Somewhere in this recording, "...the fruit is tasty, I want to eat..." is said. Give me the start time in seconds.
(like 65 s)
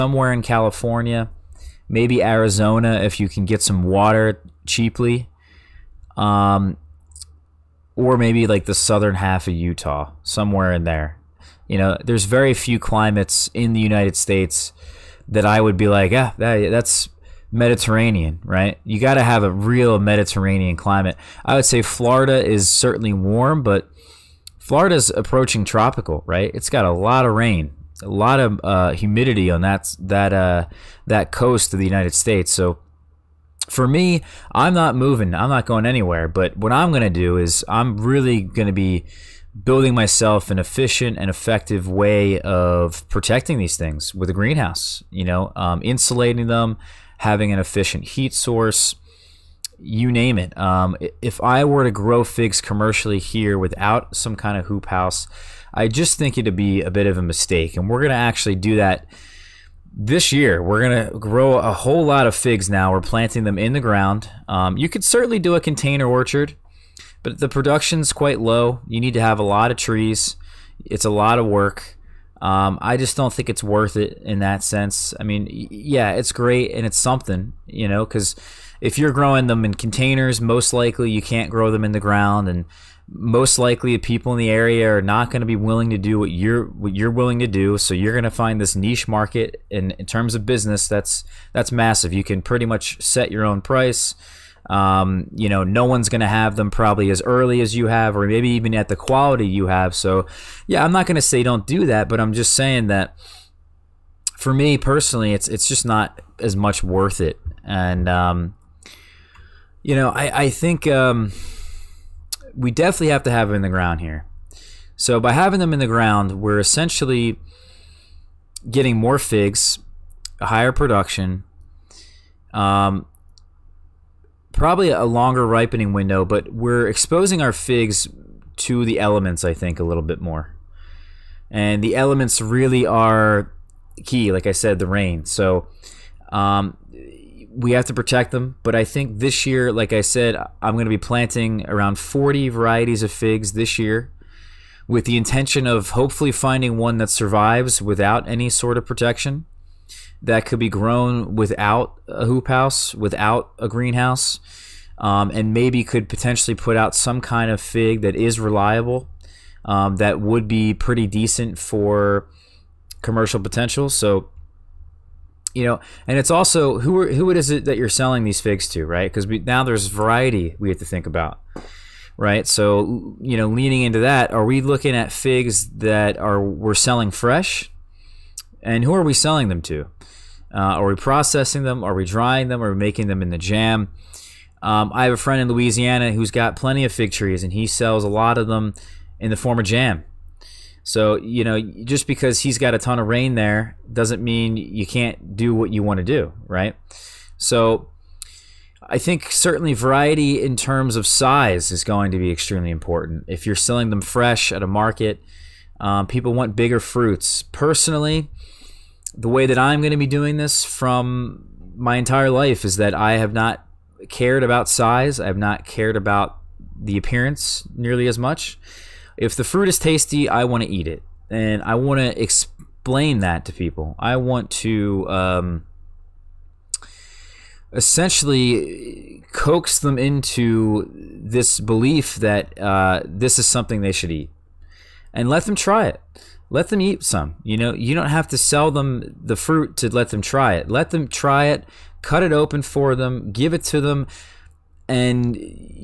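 219 s.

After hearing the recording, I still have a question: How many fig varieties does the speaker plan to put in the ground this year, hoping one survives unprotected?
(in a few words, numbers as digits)
About 40.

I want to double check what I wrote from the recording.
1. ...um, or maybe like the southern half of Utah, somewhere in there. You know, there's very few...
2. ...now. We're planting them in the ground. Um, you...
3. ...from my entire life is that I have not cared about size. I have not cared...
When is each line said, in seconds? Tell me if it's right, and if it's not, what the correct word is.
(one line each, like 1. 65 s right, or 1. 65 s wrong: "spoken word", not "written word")
1. 6 s right
2. 62 s right
3. 210 s right.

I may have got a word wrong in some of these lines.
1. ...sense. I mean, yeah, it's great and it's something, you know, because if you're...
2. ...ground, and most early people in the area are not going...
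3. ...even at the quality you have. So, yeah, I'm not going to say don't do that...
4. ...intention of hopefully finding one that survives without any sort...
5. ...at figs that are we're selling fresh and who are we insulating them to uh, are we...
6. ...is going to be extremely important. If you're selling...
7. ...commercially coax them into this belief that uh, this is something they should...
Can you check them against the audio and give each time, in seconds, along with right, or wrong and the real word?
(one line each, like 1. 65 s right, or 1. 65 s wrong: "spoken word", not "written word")
1. 74 s right
2. 82 s wrong: "likely", not "early"
3. 98 s right
4. 145 s right
5. 174 s wrong: "selling", not "insulating"
6. 201 s right
7. 227 s wrong: "essentially", not "commercially".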